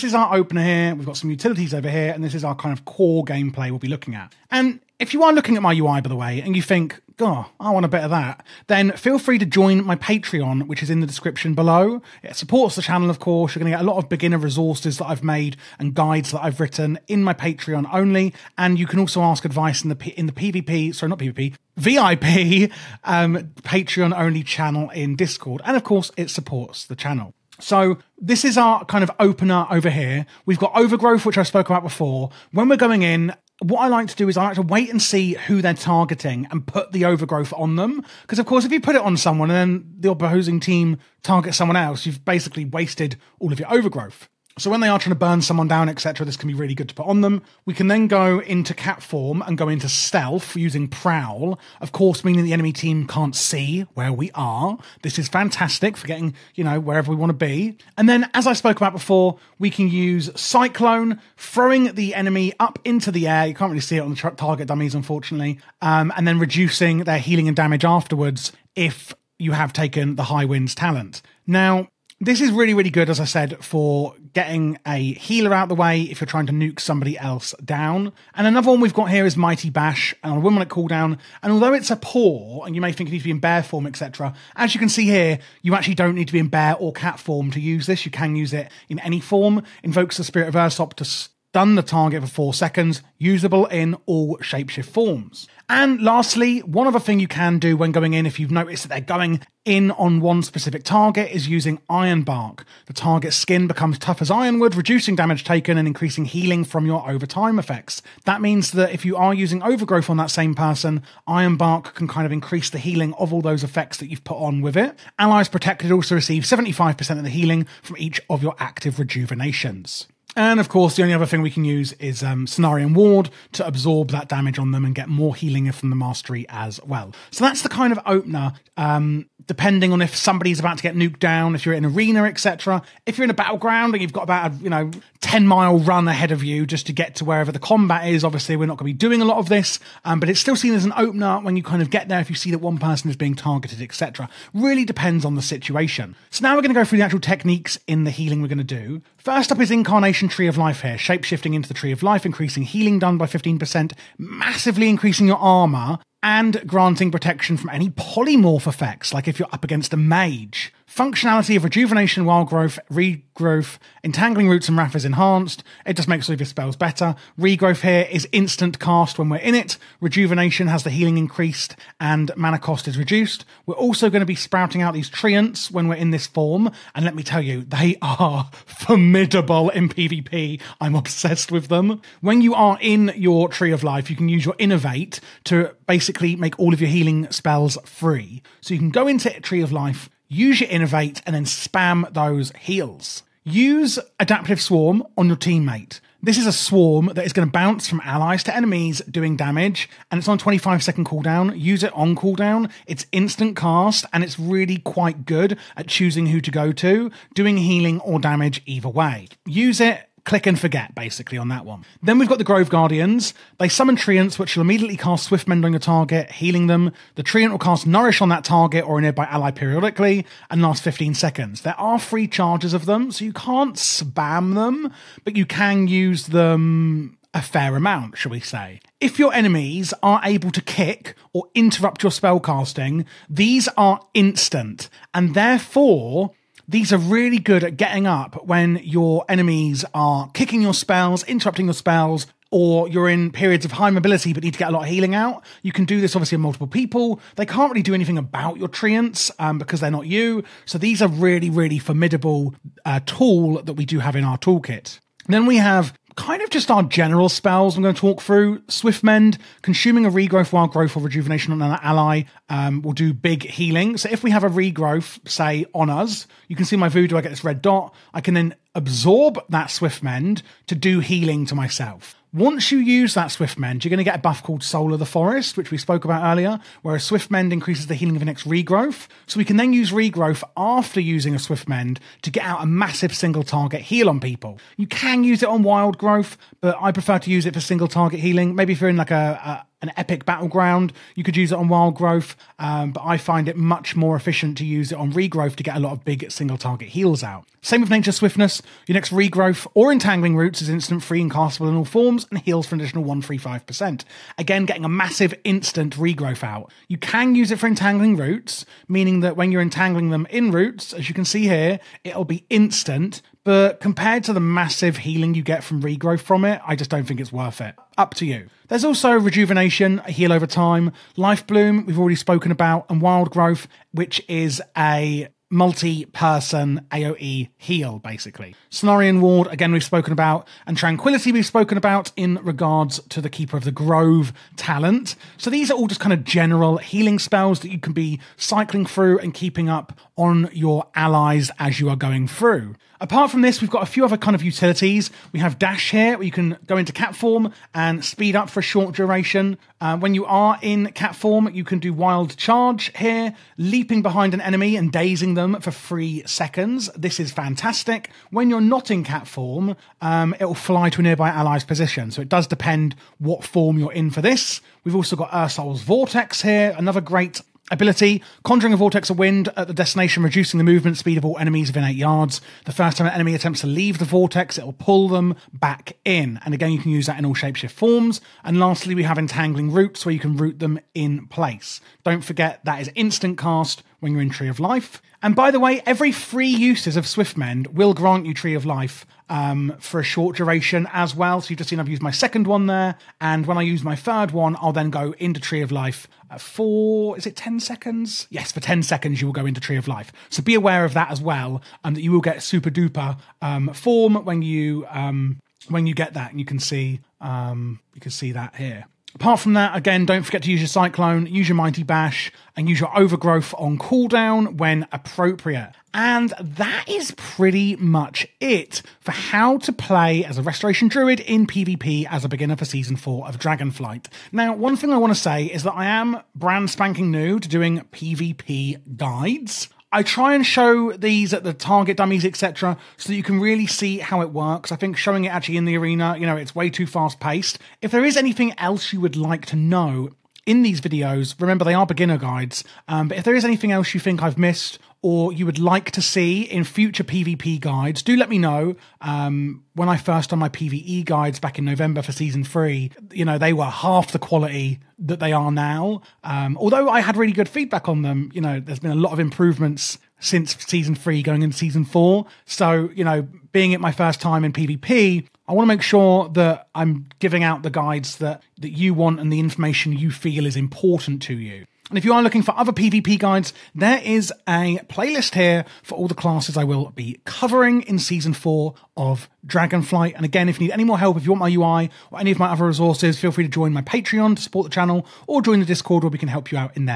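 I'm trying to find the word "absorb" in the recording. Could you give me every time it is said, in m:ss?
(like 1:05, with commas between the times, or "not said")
2:03, 4:28.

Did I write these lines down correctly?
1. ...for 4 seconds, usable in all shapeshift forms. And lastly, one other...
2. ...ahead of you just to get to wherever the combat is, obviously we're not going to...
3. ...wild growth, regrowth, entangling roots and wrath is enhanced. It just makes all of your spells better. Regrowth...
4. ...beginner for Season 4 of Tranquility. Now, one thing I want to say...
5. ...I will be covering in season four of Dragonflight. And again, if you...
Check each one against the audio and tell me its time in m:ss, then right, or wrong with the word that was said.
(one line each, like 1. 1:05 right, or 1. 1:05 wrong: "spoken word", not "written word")
1. 1:32 right
2. 2:16 right
3. 2:42 right
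4. 7:02 wrong: "Dragonflight", not "Tranquility"
5. 7:56 right.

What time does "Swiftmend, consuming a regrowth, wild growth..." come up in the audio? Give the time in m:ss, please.
4:18.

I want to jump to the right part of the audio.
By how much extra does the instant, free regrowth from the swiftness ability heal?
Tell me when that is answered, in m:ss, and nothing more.
5:03.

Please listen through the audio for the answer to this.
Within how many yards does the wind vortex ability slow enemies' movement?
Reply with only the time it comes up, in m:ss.
6:11.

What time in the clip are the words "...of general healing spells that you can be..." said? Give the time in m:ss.
5:36.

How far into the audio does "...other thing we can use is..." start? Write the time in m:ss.
2:01.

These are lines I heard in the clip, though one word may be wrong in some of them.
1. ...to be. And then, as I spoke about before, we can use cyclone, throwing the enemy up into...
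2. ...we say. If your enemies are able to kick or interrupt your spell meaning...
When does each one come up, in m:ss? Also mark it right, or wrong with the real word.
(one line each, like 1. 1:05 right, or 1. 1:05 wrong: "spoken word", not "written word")
1. 0:57 right
2. 3:48 wrong: "casting", not "meaning".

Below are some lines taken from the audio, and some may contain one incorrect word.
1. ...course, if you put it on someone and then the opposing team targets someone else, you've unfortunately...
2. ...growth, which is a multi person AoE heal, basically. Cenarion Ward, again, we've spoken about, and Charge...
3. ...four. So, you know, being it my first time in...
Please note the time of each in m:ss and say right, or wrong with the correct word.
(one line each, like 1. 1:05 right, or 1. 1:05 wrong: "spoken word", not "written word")
1. 0:38 wrong: "basically", not "unfortunately"
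2. 5:23 wrong: "Tranquility", not "Charge"
3. 7:41 right.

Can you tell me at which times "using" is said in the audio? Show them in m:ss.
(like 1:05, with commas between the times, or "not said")
0:50, 1:41, 1:49, 4:40.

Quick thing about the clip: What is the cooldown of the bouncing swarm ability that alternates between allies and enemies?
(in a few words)
25 seconds.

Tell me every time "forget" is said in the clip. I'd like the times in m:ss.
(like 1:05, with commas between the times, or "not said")
3:30, 6:22, 6:50.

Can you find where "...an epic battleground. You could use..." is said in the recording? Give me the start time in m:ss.
4:49.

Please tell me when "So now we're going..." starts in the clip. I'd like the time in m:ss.
2:26.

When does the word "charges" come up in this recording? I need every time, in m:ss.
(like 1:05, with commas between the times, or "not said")
3:42, 5:52.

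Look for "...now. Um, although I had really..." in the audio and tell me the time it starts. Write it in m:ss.
7:35.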